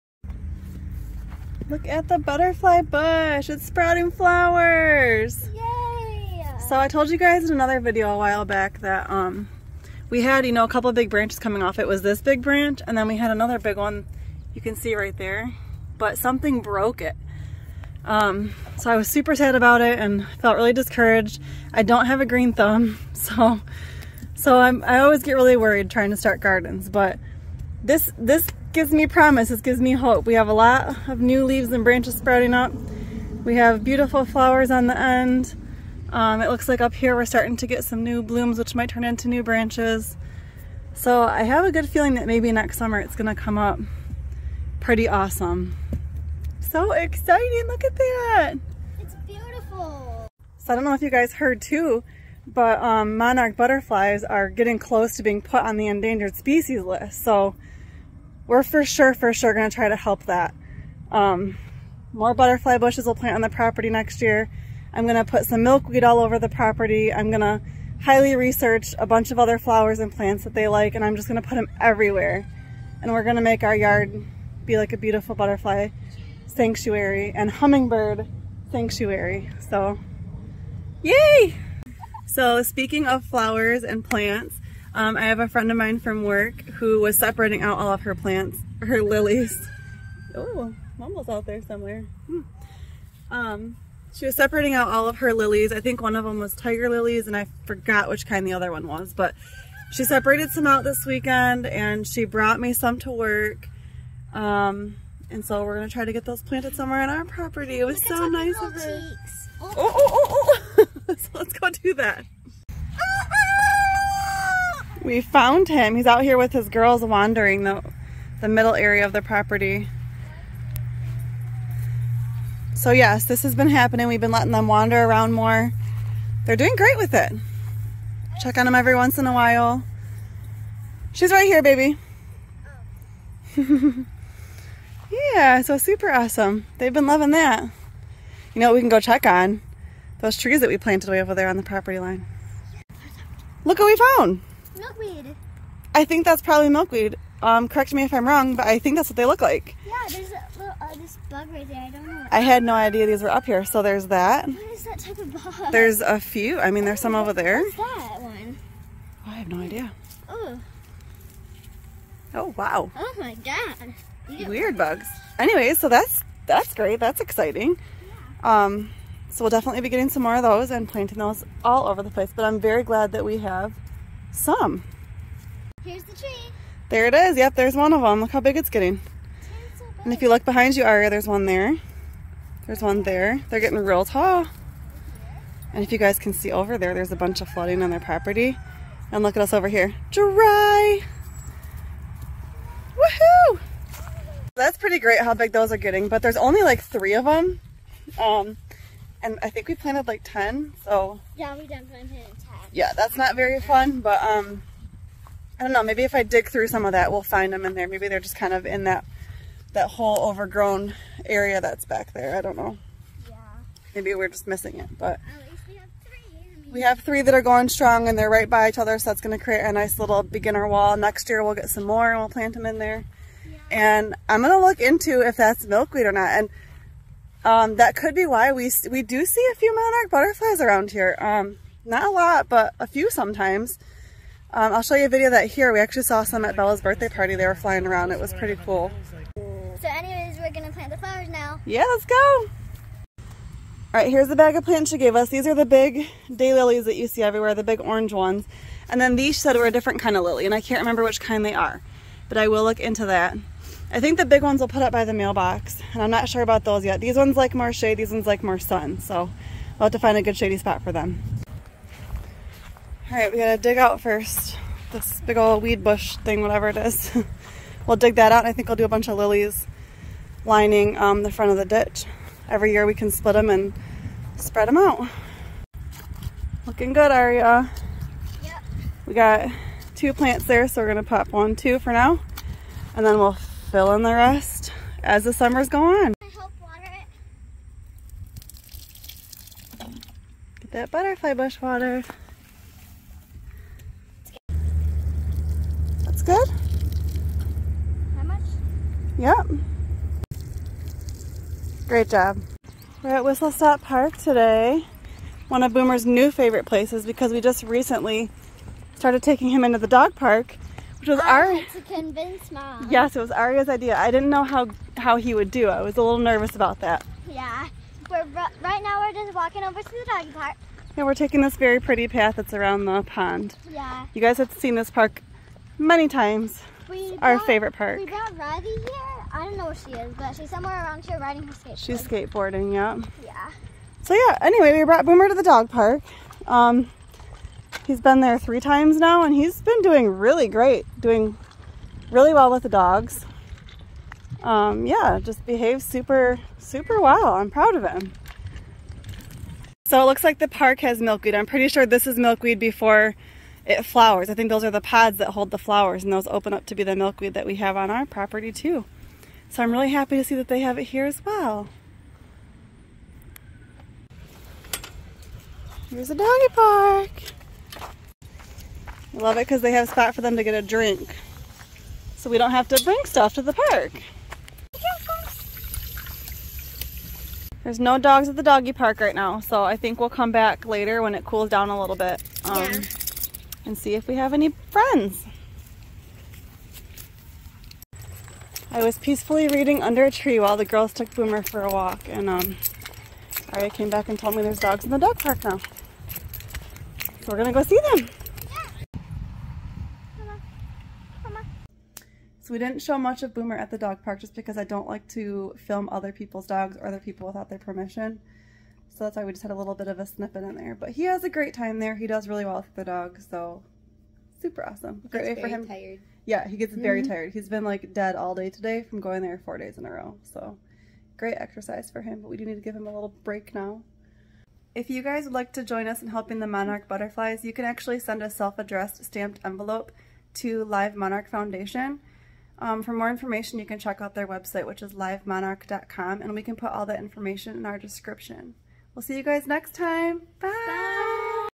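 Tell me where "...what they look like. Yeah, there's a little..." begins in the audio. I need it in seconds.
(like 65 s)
149 s.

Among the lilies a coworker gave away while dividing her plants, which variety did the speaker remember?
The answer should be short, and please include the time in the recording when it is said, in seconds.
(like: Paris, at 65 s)
Tiger lilies, at 96 s.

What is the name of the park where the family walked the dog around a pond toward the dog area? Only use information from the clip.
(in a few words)
Whistle Stop Park.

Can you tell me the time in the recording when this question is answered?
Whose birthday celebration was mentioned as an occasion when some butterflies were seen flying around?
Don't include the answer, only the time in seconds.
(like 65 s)
236 s.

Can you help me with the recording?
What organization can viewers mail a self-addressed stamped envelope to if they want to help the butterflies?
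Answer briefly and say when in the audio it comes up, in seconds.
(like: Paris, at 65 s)
Live Monarch Foundation, at 430 s.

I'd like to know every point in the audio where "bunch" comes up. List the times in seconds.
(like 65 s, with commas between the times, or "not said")
69 s, 187 s, 268 s.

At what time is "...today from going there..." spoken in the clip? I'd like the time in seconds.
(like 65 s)
418 s.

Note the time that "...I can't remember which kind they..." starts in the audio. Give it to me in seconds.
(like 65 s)
250 s.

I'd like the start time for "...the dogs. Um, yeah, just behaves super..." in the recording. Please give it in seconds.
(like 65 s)
342 s.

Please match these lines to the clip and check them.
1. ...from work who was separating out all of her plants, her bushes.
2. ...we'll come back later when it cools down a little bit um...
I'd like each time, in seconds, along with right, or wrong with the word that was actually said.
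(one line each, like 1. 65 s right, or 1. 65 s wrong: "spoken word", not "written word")
1. 85 s wrong: "lilies", not "bushes"
2. 379 s right.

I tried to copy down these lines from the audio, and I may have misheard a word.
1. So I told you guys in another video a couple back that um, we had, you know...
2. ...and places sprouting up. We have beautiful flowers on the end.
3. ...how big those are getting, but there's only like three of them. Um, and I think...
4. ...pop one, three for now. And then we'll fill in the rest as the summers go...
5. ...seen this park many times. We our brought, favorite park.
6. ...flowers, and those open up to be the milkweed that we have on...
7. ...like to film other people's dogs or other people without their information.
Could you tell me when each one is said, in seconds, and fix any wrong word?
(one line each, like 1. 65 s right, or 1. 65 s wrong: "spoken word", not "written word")
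1. 6 s wrong: "while", not "couple"
2. 31 s wrong: "branches", not "places"
3. 195 s right
4. 281 s wrong: "two", not "three"
5. 324 s right
6. 355 s right
7. 404 s wrong: "permission", not "information".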